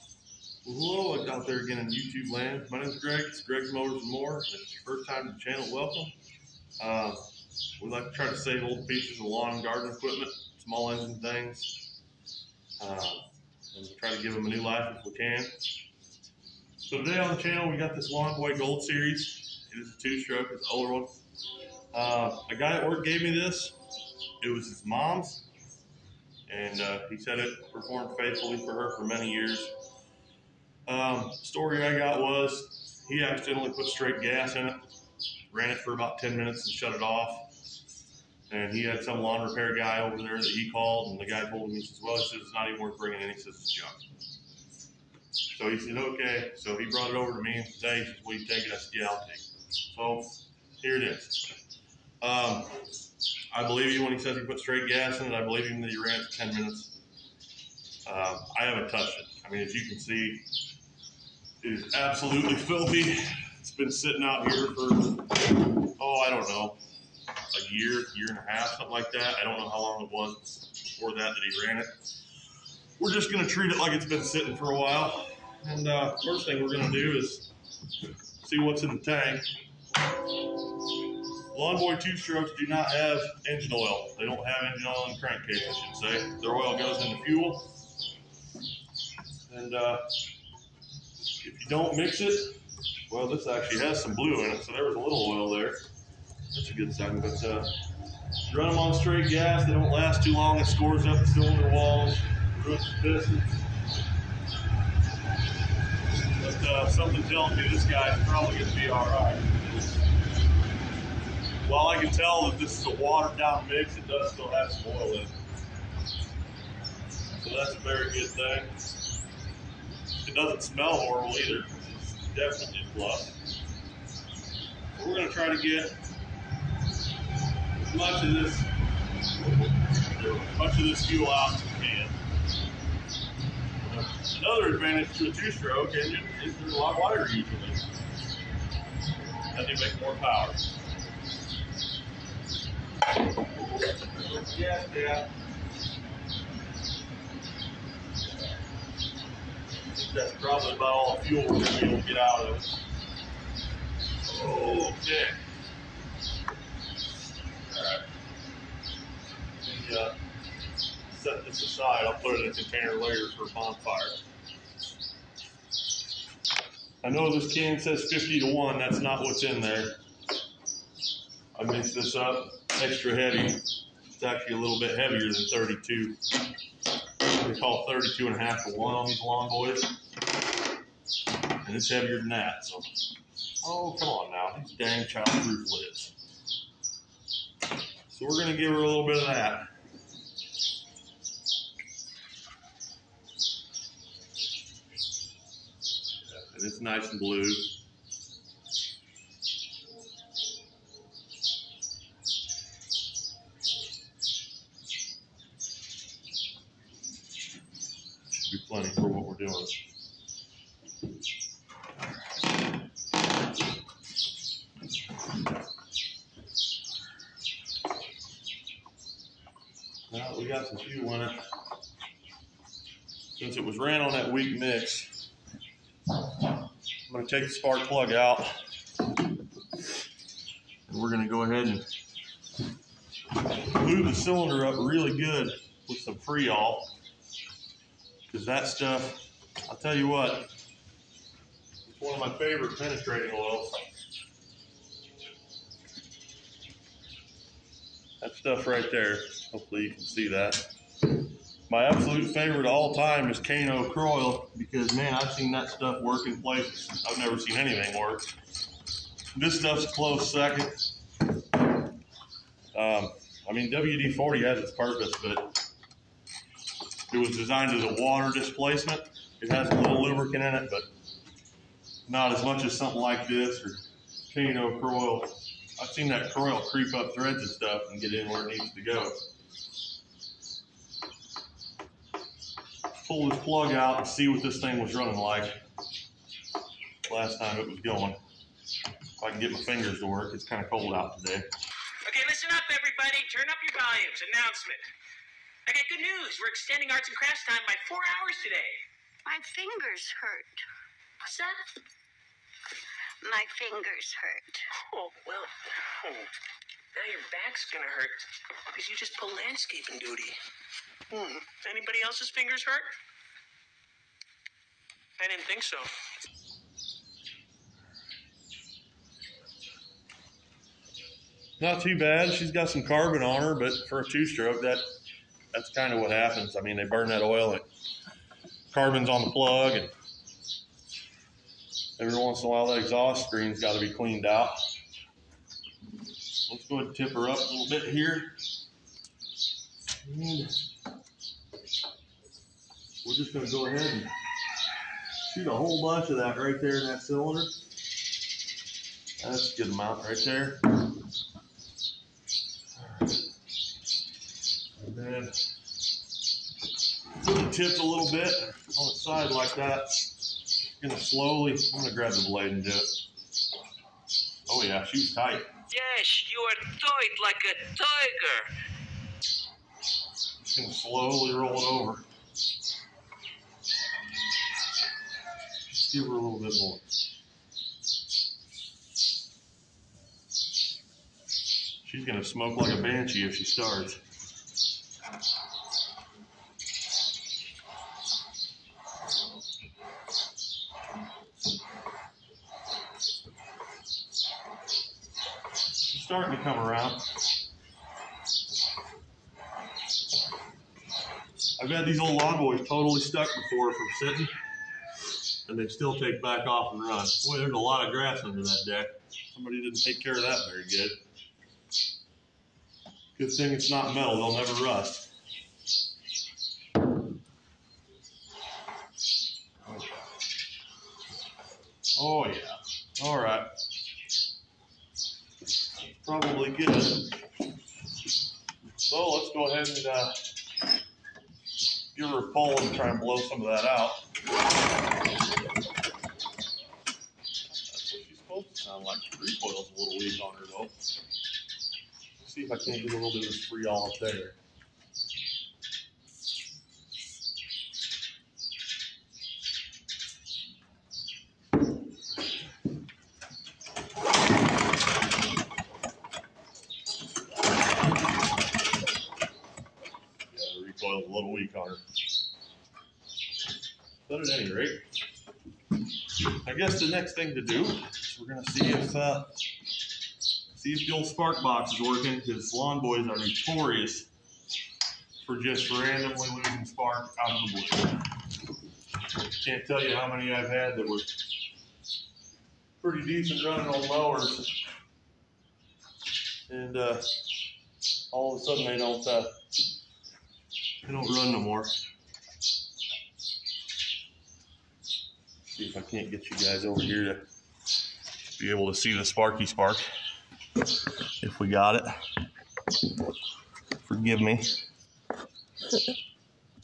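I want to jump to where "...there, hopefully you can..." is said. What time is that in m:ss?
4:08.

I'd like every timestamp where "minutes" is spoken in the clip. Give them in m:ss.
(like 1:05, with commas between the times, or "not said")
0:36, 0:56.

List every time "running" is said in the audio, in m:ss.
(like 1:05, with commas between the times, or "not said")
4:44, 8:03.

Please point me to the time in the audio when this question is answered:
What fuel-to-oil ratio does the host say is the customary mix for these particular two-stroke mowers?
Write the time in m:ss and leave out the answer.
2:57.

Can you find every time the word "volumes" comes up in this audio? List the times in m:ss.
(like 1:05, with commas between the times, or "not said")
4:53.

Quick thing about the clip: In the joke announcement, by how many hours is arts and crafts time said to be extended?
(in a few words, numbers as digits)
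4 hours.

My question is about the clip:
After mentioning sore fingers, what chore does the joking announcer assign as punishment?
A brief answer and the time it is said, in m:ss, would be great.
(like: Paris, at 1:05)
Landscaping duty, at 5:09.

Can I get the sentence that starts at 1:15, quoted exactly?
And uh, first thing we're going to do is see what's in the tank.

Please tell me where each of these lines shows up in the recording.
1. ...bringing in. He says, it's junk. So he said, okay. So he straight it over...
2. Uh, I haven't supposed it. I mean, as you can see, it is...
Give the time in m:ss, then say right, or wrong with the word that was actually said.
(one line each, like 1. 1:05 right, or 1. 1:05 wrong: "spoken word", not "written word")
1. 0:42 wrong: "brought", not "straight"
2. 0:58 wrong: "touched", not "supposed".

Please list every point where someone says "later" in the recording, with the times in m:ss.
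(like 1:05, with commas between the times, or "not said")
2:42.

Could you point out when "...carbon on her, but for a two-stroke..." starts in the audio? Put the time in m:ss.
5:22.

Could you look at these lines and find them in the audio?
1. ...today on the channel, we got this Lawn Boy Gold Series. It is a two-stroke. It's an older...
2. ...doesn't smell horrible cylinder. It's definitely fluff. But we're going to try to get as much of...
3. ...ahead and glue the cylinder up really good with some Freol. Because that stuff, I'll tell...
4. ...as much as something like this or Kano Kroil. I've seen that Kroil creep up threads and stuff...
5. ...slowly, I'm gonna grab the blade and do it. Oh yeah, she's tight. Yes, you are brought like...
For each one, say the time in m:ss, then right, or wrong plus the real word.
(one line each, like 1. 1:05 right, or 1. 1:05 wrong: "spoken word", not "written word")
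1. 0:16 right
2. 2:00 wrong: "either", not "cylinder"
3. 3:51 right
4. 4:32 right
5. 6:00 wrong: "tight", not "brought".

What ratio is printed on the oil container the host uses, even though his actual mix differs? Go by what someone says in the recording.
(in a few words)
50 to 1.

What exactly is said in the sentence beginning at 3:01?
And it's heavier than that, so.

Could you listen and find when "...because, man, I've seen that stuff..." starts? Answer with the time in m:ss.
4:14.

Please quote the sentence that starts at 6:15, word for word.
Just give her a little bit more.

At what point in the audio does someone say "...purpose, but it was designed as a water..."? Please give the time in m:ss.
4:24.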